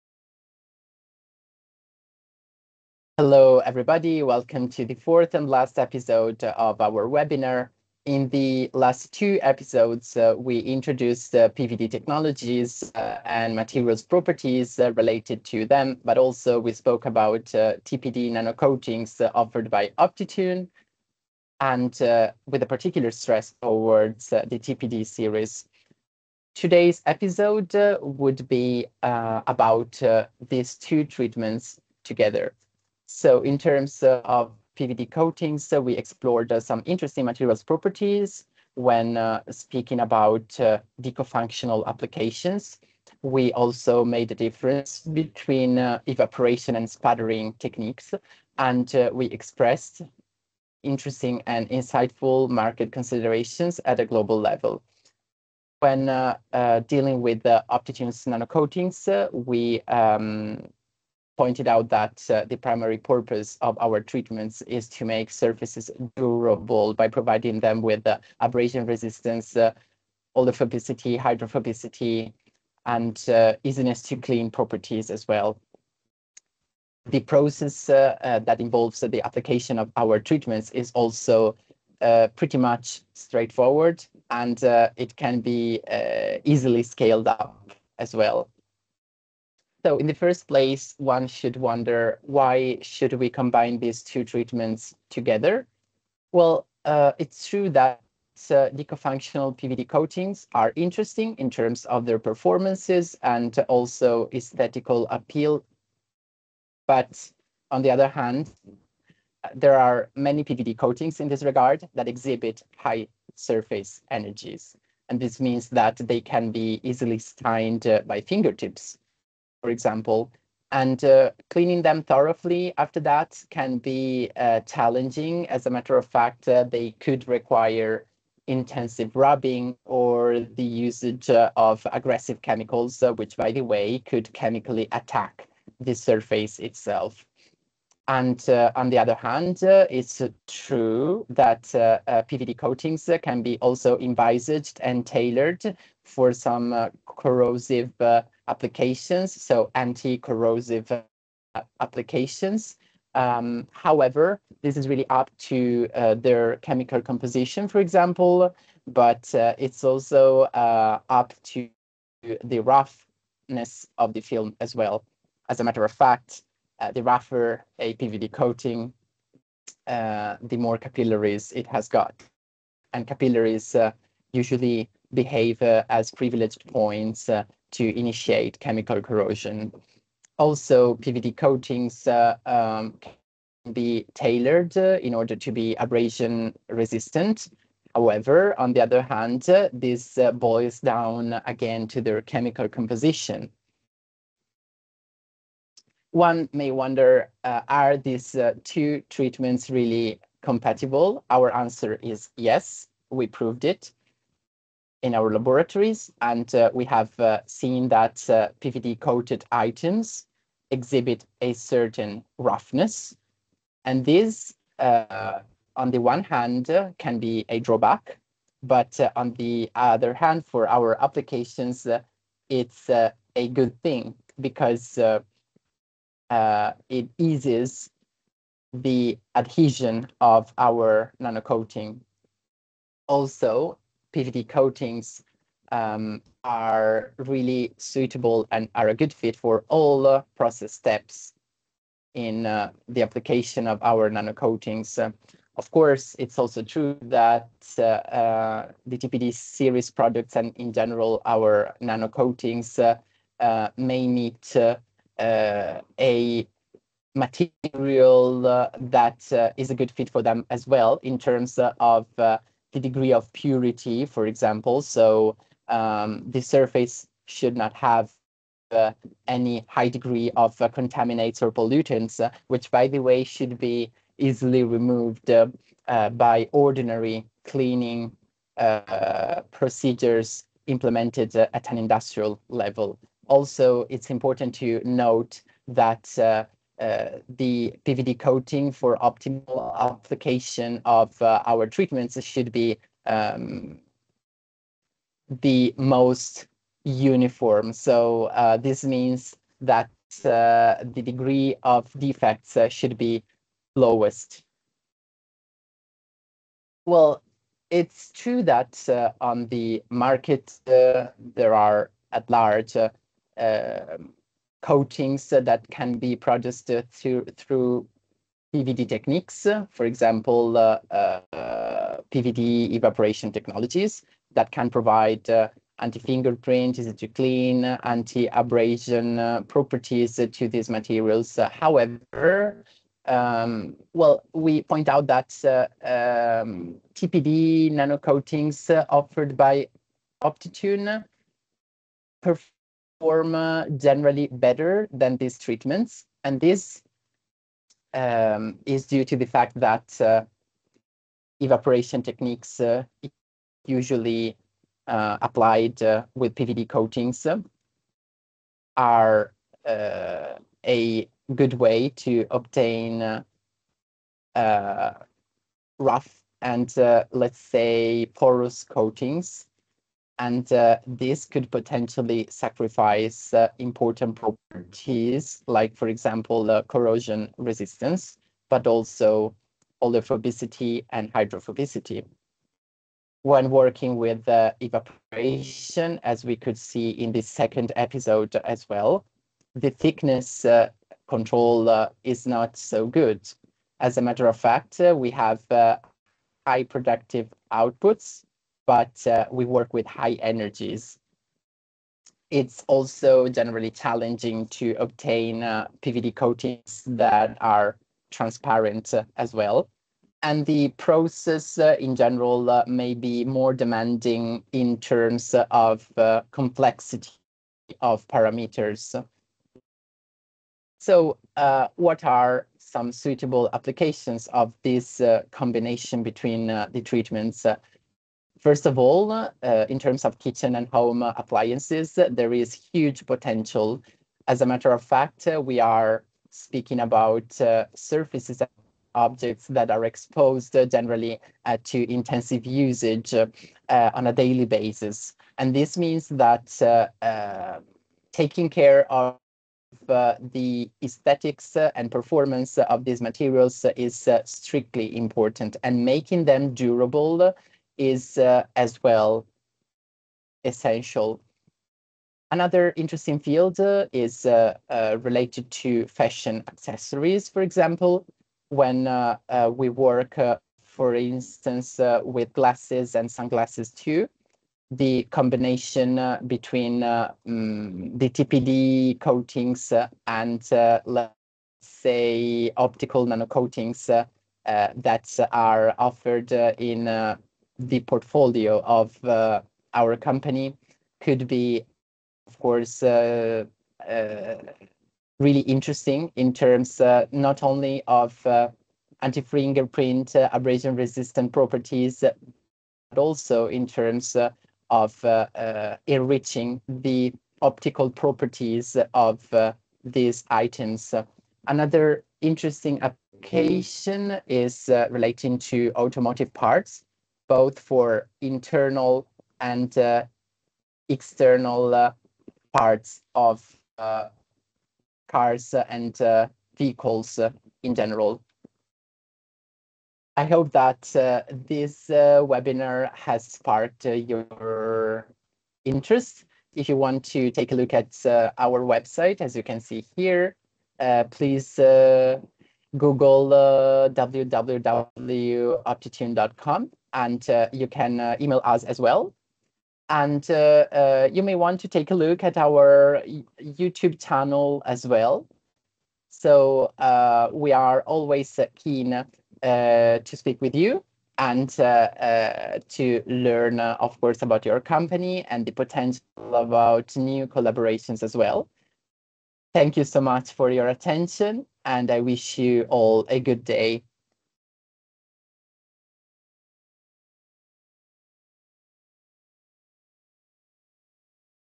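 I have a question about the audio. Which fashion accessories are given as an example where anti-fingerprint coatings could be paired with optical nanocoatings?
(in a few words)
glasses and sunglasses.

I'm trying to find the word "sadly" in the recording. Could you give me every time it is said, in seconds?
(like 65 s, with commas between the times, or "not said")
not said.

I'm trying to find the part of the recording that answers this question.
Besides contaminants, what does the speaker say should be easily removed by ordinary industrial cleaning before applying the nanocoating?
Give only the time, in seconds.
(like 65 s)
271 s.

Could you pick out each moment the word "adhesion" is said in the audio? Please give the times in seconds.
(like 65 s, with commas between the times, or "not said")
229 s.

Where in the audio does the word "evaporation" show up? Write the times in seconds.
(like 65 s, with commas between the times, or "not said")
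46 s, 322 s, 351 s, 384 s.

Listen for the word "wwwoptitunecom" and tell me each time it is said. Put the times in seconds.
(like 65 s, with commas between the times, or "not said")
543 s.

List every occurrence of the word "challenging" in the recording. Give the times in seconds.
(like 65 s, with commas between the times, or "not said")
124 s, 403 s.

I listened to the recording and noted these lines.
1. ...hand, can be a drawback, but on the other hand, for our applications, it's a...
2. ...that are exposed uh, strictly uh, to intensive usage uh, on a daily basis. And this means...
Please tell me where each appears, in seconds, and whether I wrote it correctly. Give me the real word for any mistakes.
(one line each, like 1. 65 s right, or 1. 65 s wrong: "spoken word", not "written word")
1. 216 s right
2. 439 s wrong: "generally", not "strictly".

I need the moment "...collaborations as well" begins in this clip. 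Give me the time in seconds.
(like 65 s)
567 s.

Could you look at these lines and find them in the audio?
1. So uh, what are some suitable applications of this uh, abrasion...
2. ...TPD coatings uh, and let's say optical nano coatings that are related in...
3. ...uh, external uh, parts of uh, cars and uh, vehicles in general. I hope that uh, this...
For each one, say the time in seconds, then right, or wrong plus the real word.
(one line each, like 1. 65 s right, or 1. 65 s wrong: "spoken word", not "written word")
1. 420 s wrong: "combination", not "abrasion"
2. 478 s wrong: "offered", not "related"
3. 519 s right.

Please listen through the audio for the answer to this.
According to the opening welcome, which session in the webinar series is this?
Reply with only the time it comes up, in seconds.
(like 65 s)
4 s.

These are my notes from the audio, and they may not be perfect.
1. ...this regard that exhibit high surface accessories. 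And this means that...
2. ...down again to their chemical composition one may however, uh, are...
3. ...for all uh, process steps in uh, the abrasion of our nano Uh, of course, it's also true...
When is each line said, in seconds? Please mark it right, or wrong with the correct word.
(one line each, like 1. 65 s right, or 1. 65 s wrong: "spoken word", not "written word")
1. 111 s wrong: "energies", not "accessories"
2. 190 s wrong: "wonder", not "however"
3. 239 s wrong: "application", not "abrasion".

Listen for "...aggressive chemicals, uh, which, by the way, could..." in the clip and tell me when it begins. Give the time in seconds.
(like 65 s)
131 s.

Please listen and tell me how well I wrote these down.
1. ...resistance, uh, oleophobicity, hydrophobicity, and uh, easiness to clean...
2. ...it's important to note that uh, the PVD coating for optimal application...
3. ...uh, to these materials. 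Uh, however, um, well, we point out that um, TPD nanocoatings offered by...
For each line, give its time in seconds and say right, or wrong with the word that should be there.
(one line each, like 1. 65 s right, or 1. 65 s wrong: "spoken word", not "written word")
1. 68 s right
2. 283 s right
3. 330 s right.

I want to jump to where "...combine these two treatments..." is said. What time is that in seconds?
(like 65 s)
93 s.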